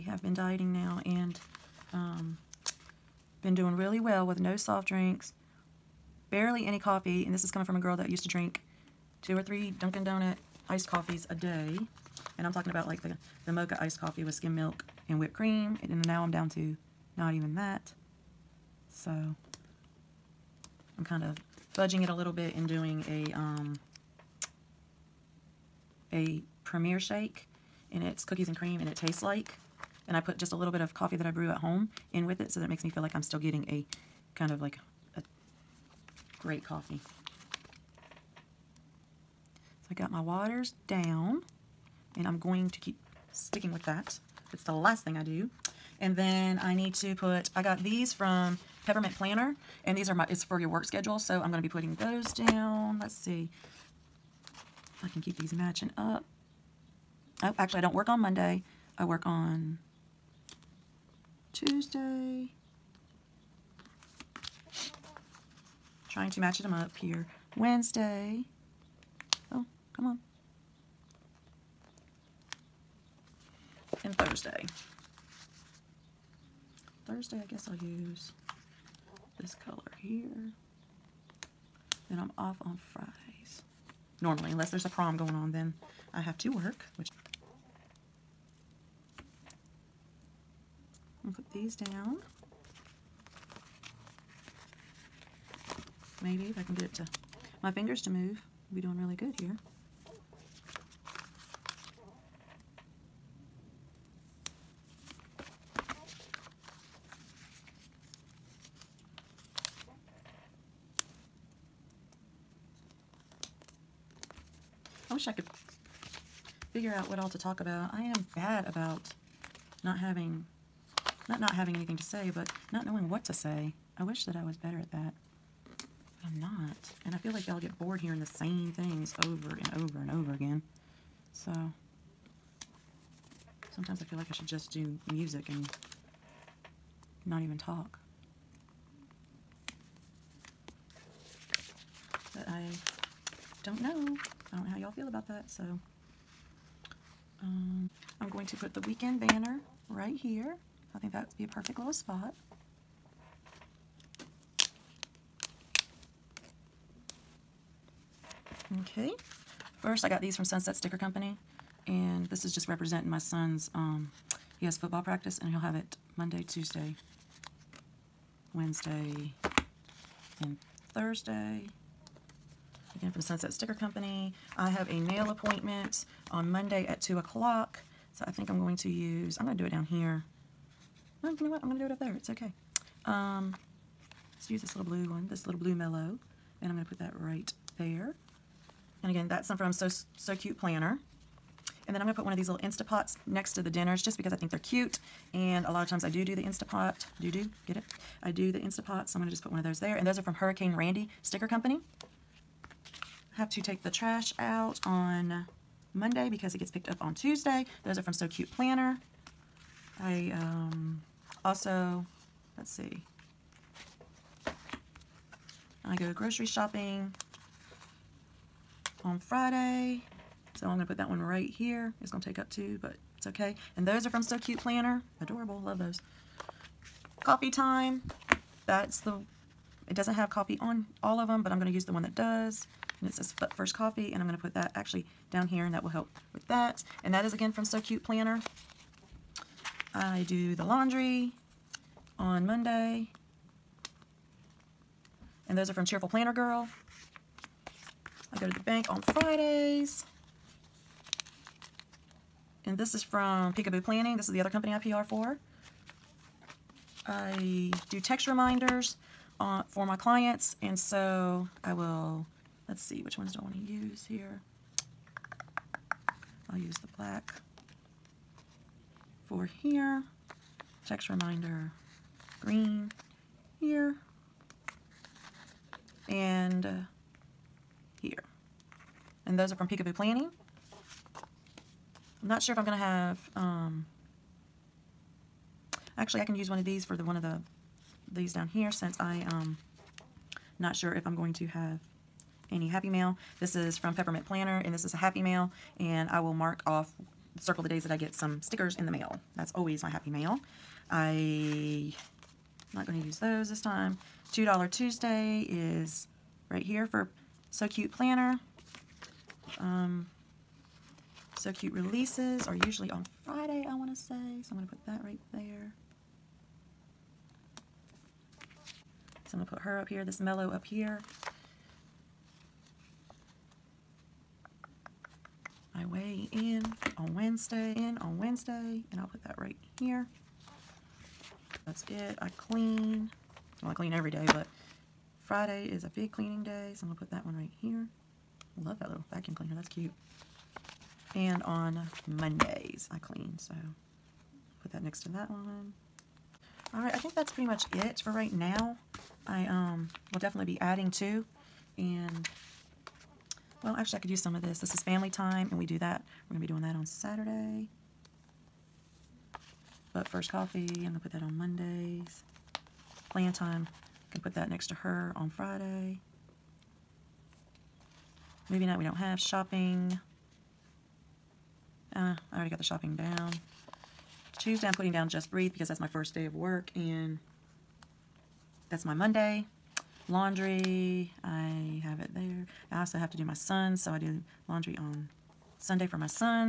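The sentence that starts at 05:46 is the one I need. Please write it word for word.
All right, I think that's pretty much it for right now.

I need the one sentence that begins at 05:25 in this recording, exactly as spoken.
I weigh in on Wednesday, in on Wednesday, and I'll put that right here.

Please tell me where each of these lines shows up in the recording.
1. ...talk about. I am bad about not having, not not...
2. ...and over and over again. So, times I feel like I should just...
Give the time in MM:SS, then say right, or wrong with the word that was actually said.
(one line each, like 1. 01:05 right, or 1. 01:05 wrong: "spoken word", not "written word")
1. 01:57 right
2. 02:09 wrong: "sometimes", not "times".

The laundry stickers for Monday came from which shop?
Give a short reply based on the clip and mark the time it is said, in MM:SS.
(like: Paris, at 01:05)
Cheerful Planner Girl, at 04:05.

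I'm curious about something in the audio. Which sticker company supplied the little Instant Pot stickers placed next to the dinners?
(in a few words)
Hurricane Randi Sticker Company.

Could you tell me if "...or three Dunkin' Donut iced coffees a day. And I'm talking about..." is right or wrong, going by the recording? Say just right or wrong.
right.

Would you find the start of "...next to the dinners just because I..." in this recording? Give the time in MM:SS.
03:13.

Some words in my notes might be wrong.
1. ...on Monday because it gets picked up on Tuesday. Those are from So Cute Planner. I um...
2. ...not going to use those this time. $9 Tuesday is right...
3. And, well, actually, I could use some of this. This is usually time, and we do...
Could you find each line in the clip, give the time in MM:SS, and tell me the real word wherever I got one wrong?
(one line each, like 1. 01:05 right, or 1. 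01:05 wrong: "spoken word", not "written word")
1. 03:24 right
2. 05:02 wrong: "2", not "9"
3. 05:51 wrong: "family", not "usually".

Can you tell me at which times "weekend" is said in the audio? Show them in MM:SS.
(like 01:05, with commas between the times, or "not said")
02:28.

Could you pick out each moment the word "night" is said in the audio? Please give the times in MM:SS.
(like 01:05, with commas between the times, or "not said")
06:08.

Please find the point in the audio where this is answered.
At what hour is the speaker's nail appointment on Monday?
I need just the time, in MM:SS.
02:57.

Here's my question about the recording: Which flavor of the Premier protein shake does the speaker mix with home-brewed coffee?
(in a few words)
Cookies and cream.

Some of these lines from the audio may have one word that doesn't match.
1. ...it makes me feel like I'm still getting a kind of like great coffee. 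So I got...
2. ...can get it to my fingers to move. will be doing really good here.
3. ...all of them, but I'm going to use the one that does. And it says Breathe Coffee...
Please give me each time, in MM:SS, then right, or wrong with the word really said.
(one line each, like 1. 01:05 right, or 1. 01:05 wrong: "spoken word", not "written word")
1. 00:32 right
2. 01:36 right
3. 03:51 wrong: "First", not "Breathe".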